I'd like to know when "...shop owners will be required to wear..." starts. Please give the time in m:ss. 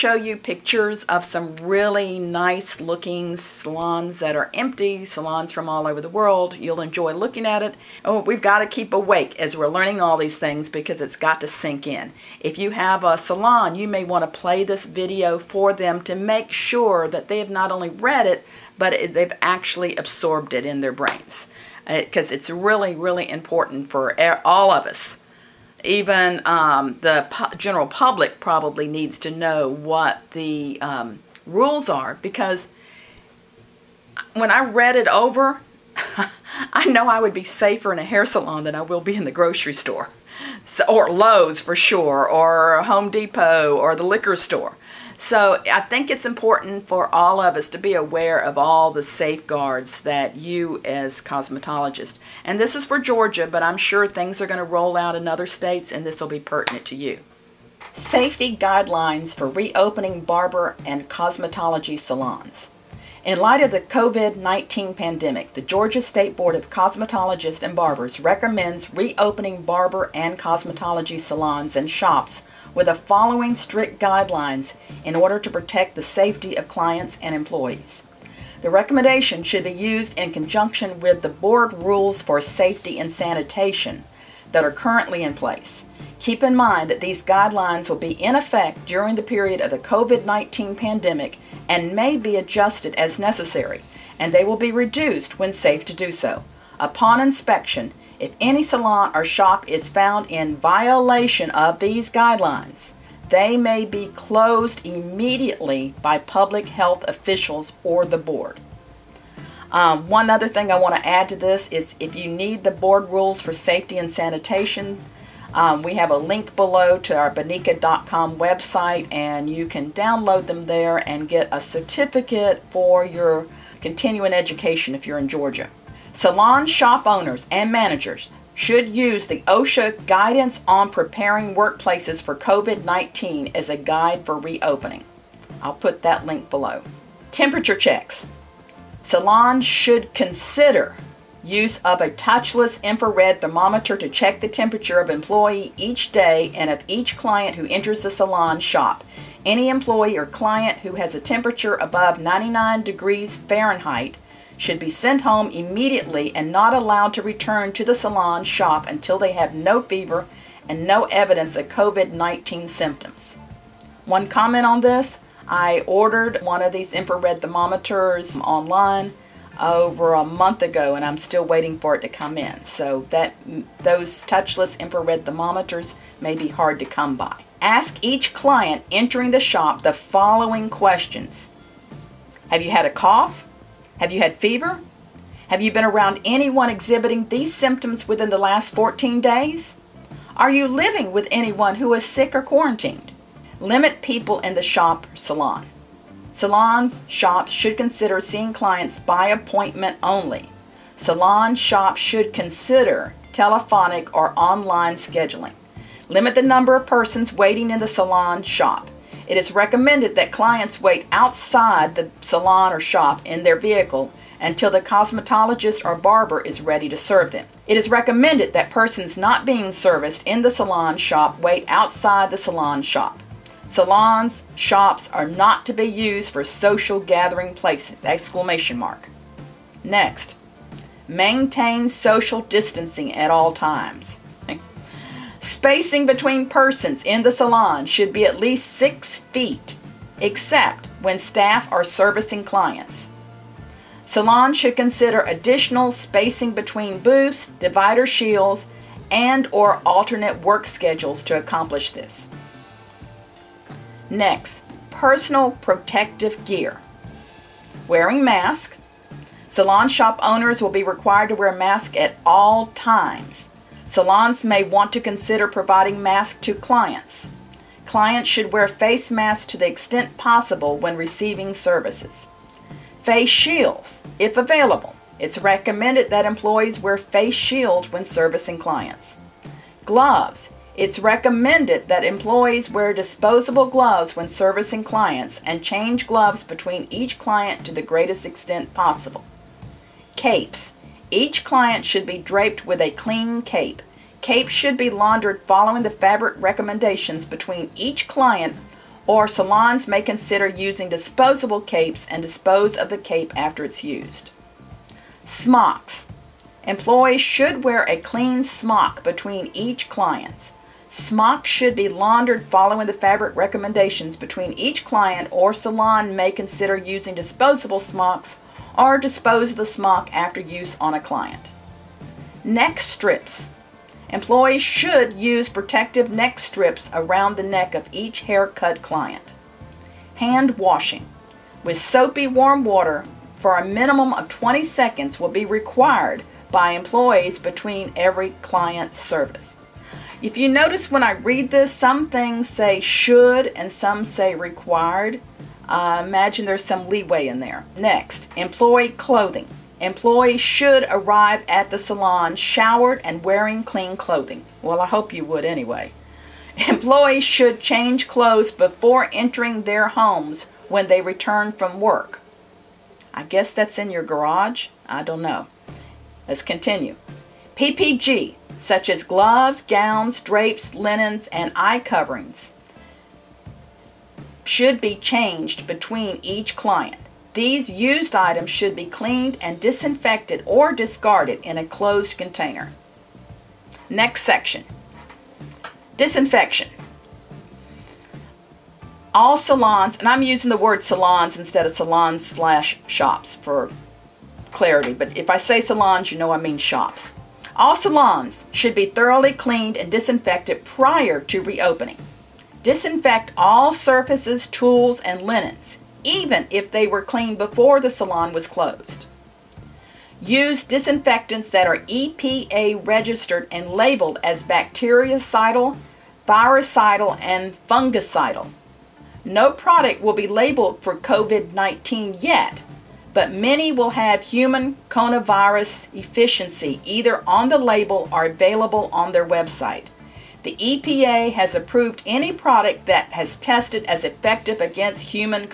4:19.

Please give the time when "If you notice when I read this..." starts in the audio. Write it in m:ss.
5:40.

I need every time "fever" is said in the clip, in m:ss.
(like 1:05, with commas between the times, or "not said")
2:39, 3:04.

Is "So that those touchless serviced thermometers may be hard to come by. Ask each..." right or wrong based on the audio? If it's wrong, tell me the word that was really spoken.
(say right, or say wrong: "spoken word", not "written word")
wrong: "infrared", not "serviced".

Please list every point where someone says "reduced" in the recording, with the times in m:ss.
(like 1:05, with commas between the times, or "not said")
1:34.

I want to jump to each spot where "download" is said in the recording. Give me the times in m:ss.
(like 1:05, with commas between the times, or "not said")
1:59.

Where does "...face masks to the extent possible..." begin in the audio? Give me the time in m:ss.
4:28.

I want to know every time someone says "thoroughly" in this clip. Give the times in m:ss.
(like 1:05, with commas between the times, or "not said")
6:38.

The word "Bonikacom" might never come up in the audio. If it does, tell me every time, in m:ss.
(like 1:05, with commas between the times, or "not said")
1:57.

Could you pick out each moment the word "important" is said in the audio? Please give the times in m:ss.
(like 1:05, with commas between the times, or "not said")
0:23, 0:46.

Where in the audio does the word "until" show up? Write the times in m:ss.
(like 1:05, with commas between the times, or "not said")
2:38, 3:34.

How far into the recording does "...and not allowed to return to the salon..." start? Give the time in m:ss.
2:36.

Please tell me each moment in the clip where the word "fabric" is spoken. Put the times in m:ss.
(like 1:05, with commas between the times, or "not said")
4:55, 5:12.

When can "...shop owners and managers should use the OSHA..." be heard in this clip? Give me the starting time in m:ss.
2:06.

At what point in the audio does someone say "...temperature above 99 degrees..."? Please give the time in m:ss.
2:31.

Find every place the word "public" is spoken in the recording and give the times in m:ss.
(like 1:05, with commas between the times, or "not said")
0:27, 1:46.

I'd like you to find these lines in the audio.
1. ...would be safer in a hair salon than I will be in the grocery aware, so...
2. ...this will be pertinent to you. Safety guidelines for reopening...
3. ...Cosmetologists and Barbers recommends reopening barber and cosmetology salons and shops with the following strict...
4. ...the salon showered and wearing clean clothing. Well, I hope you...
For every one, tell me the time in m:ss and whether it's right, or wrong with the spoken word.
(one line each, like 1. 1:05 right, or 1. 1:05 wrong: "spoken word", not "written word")
1. 0:37 wrong: "store", not "aware"
2. 0:56 right
3. 1:06 right
4. 5:51 right.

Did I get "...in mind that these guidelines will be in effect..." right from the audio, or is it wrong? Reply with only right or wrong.
right.